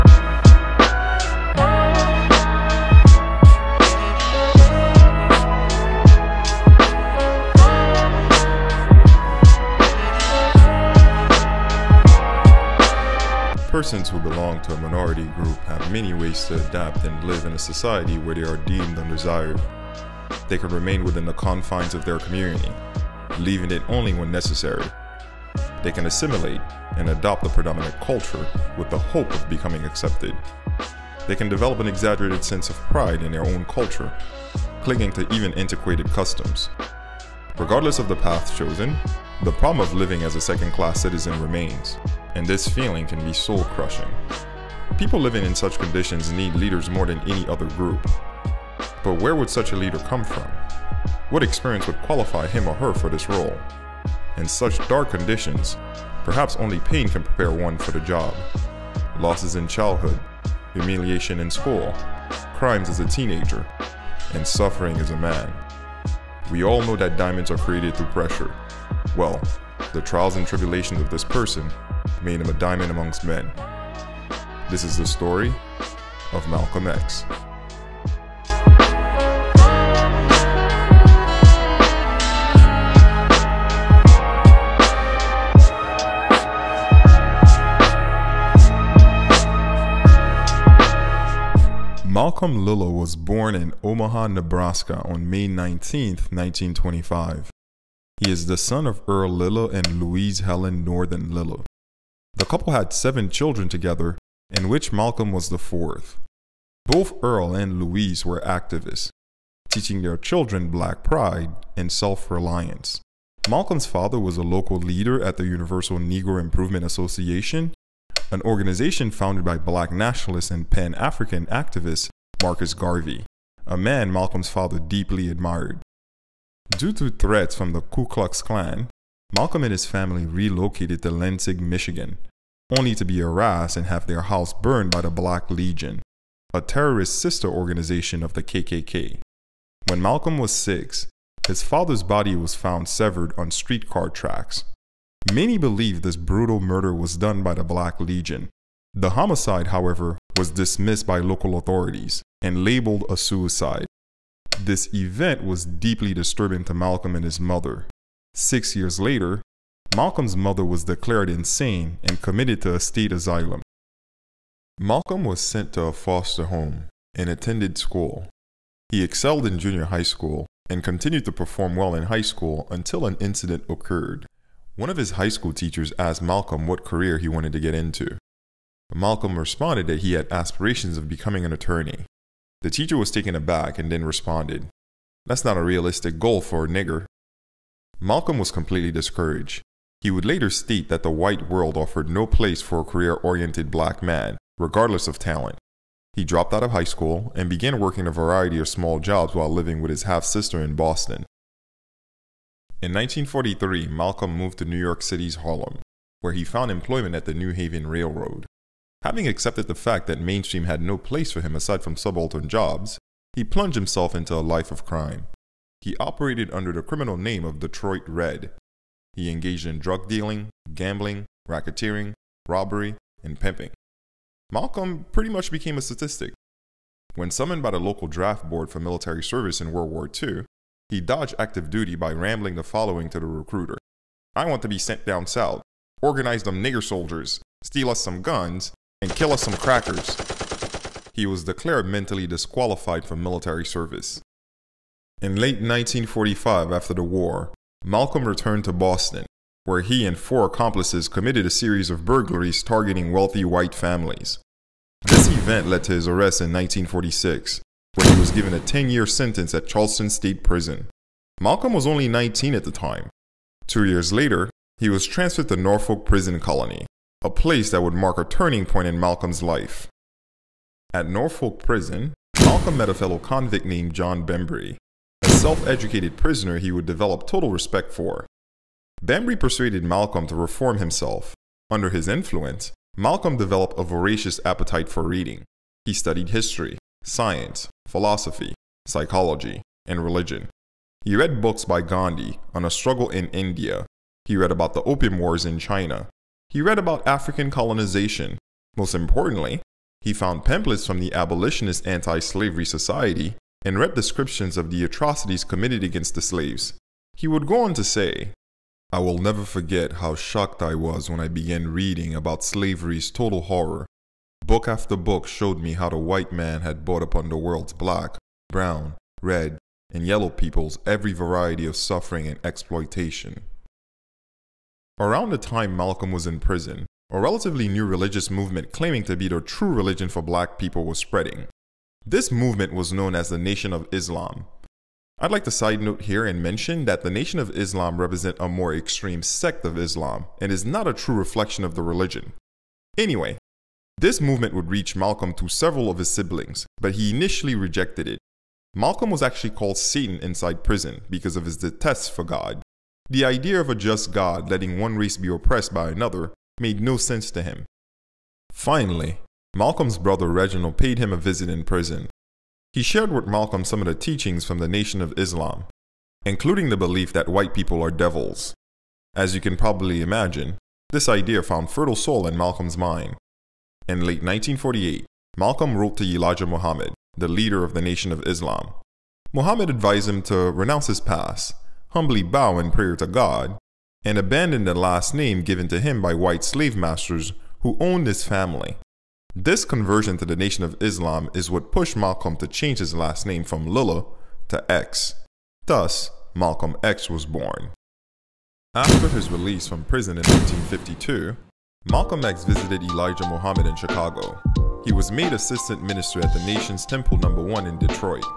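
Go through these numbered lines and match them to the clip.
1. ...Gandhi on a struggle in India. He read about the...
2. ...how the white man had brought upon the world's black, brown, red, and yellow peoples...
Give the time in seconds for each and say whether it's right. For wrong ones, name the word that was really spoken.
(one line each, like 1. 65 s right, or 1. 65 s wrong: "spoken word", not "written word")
1. 291 s right
2. 315 s right.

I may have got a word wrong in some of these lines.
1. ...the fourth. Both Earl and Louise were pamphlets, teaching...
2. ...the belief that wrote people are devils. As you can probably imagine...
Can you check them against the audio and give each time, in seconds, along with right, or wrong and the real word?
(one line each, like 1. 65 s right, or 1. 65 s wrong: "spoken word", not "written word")
1. 105 s wrong: "activists", not "pamphlets"
2. 366 s wrong: "white", not "wrote".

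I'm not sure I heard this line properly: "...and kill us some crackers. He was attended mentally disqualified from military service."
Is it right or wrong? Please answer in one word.
wrong.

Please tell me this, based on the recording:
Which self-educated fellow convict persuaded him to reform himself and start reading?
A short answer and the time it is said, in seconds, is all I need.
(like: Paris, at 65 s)
John Bembry, at 273 s.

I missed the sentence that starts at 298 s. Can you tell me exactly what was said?
Most importantly, he found pamphlets from the abolitionist anti-slavery society and read descriptions of the atrocities committed against the slaves.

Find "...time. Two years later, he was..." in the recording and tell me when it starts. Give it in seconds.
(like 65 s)
262 s.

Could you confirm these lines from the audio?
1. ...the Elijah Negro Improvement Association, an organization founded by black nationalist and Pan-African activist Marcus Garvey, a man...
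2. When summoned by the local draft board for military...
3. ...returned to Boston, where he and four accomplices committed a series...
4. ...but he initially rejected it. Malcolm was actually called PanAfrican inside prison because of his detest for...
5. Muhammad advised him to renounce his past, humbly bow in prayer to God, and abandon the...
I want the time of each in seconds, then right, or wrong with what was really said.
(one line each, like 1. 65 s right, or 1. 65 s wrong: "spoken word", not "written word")
1. 115 s wrong: "Universal", not "Elijah"
2. 227 s right
3. 248 s right
4. 346 s wrong: "Satan", not "PanAfrican"
5. 379 s right.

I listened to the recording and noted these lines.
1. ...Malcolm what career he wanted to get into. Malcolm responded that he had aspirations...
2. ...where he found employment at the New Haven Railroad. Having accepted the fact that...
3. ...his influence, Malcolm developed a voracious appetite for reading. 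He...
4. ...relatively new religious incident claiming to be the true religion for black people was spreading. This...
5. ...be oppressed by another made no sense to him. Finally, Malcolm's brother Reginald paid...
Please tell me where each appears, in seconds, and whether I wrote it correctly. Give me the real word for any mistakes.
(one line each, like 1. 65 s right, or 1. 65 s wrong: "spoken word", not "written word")
1. 176 s right
2. 206 s right
3. 281 s right
4. 327 s wrong: "movement", not "incident"
5. 355 s right.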